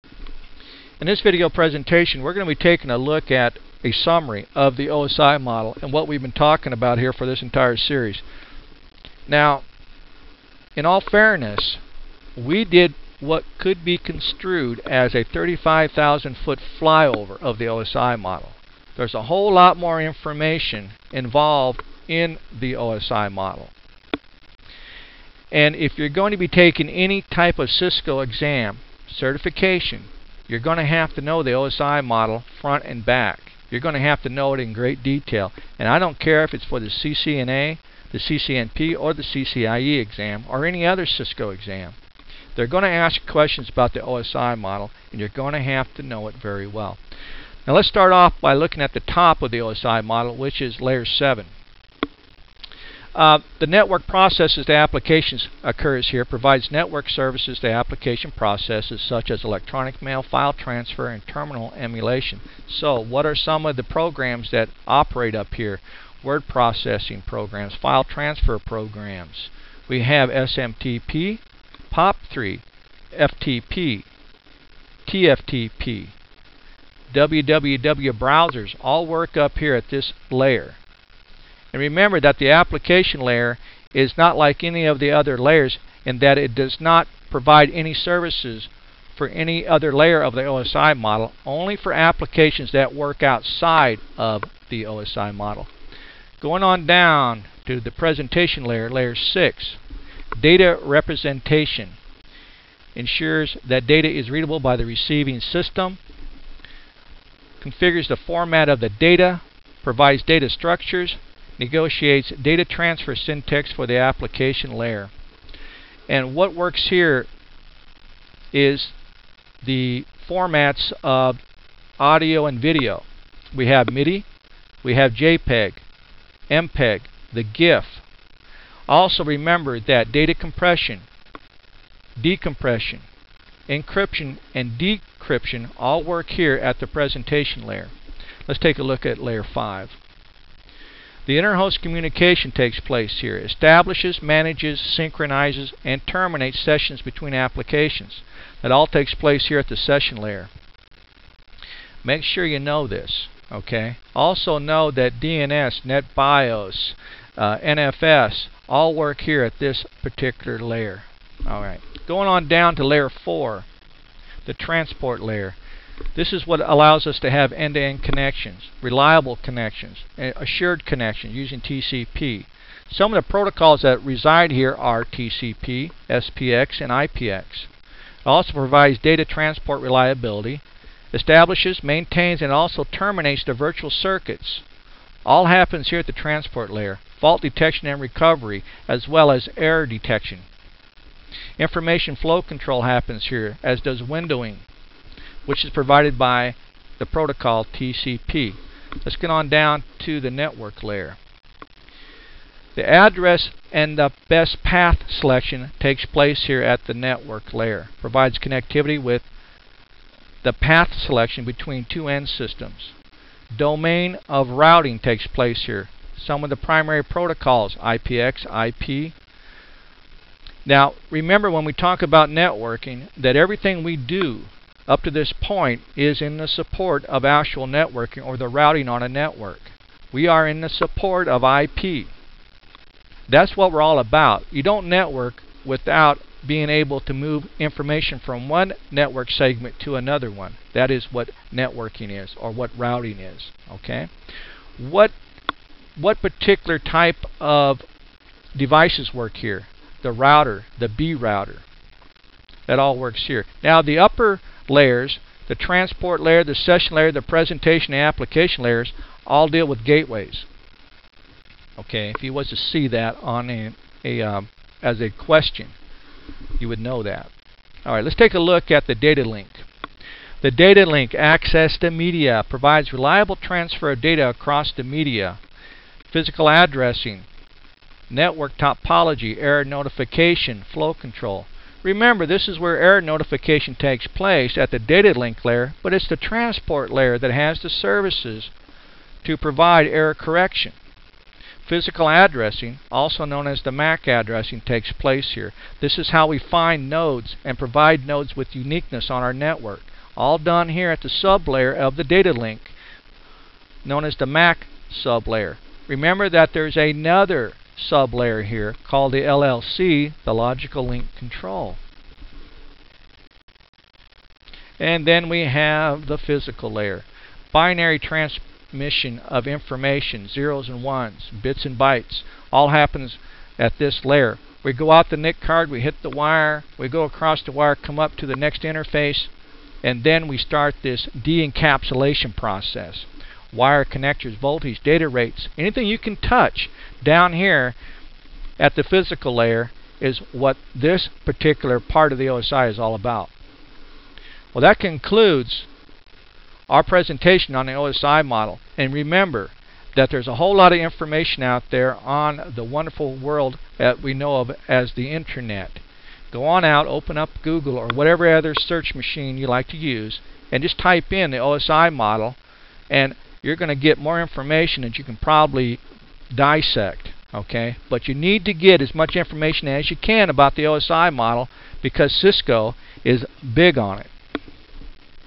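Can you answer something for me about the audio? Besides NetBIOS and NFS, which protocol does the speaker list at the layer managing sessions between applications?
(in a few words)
DNS.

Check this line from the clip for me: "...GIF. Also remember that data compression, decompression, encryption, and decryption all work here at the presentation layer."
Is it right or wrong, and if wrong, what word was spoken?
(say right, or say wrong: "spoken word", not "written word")
right.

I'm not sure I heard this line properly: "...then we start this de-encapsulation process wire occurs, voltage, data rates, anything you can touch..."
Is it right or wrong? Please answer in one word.
wrong.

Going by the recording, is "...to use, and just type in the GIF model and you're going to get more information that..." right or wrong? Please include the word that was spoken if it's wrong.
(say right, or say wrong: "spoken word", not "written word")
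wrong: "OSI", not "GIF".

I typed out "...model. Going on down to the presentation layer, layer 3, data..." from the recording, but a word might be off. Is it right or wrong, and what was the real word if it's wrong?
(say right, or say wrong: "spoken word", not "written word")
wrong: "6", not "3".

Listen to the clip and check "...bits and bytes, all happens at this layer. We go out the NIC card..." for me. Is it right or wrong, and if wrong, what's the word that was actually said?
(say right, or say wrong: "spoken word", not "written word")
right.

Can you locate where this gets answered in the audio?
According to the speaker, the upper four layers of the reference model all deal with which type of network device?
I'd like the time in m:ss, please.
4:19.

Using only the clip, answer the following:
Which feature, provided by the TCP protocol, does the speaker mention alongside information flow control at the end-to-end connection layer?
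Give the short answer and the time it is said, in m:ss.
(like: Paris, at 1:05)
windowing, at 3:14.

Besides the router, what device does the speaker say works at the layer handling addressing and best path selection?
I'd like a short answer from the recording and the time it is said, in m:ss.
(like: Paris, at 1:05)
B router, at 4:10.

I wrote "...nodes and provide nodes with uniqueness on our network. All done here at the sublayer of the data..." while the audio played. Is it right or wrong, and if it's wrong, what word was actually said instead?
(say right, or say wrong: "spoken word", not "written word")
right.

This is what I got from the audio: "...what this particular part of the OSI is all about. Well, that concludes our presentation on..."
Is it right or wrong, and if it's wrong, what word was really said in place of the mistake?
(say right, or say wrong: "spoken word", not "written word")
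right.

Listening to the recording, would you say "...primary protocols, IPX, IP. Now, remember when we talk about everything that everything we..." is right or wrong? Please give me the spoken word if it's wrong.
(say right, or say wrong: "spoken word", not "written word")
wrong: "networking", not "everything".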